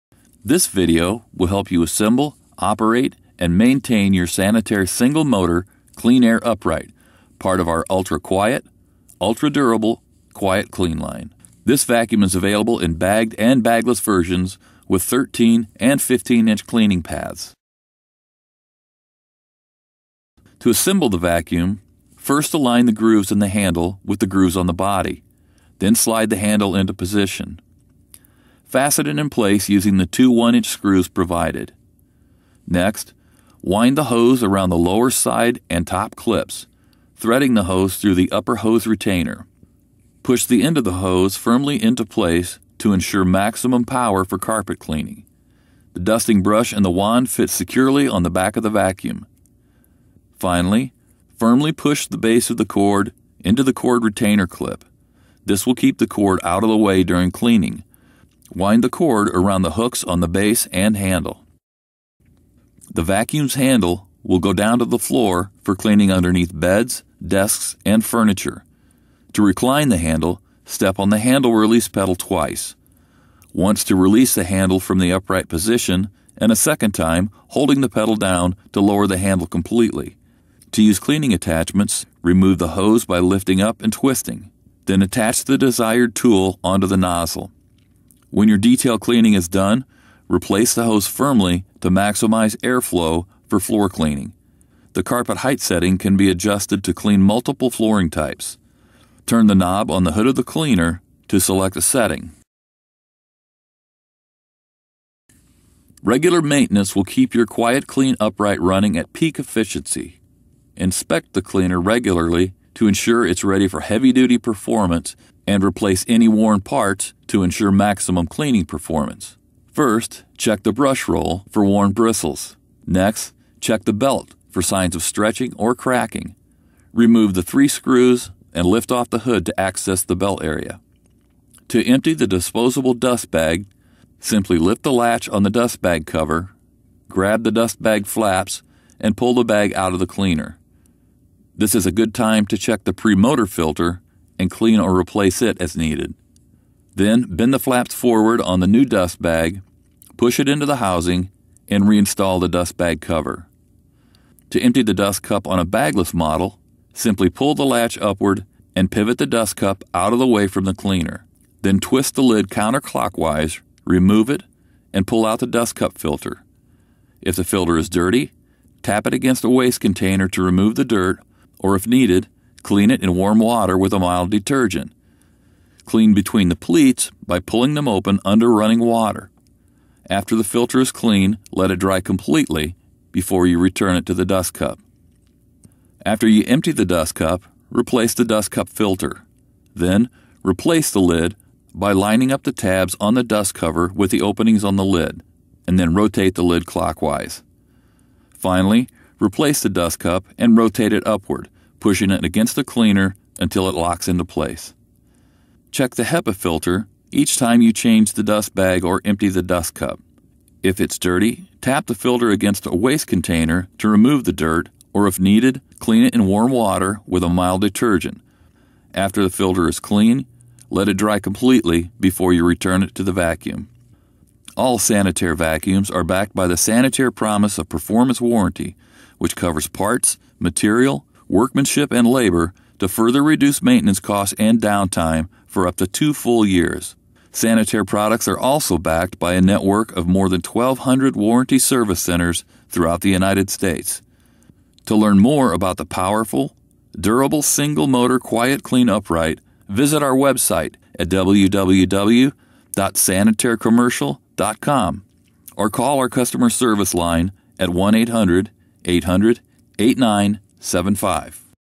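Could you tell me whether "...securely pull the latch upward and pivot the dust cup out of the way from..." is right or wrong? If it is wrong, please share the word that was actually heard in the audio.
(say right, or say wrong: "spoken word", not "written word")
wrong: "simply", not "securely".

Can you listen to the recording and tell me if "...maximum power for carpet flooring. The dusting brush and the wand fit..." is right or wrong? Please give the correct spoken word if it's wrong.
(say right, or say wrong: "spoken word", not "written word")
wrong: "cleaning", not "flooring".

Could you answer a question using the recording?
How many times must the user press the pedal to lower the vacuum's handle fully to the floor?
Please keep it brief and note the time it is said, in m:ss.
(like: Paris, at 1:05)
Twice, at 1:12.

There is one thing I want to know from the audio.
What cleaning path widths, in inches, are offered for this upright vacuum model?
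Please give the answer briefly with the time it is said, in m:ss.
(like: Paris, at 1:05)
13 and 15 inch, at 0:15.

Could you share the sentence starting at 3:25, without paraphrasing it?
Check the HEPA filter each time you change the dust bag or empty the dust cup.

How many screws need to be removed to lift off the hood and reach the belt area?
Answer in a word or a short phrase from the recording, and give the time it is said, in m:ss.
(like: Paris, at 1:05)
3, at 2:07.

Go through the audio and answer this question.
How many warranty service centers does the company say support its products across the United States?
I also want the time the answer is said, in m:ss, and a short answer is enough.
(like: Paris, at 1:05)
More than 1,200, at 4:00.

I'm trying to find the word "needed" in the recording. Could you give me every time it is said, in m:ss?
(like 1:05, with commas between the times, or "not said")
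2:25, 2:51, 3:35.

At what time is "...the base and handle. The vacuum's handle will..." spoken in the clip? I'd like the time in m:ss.
1:00.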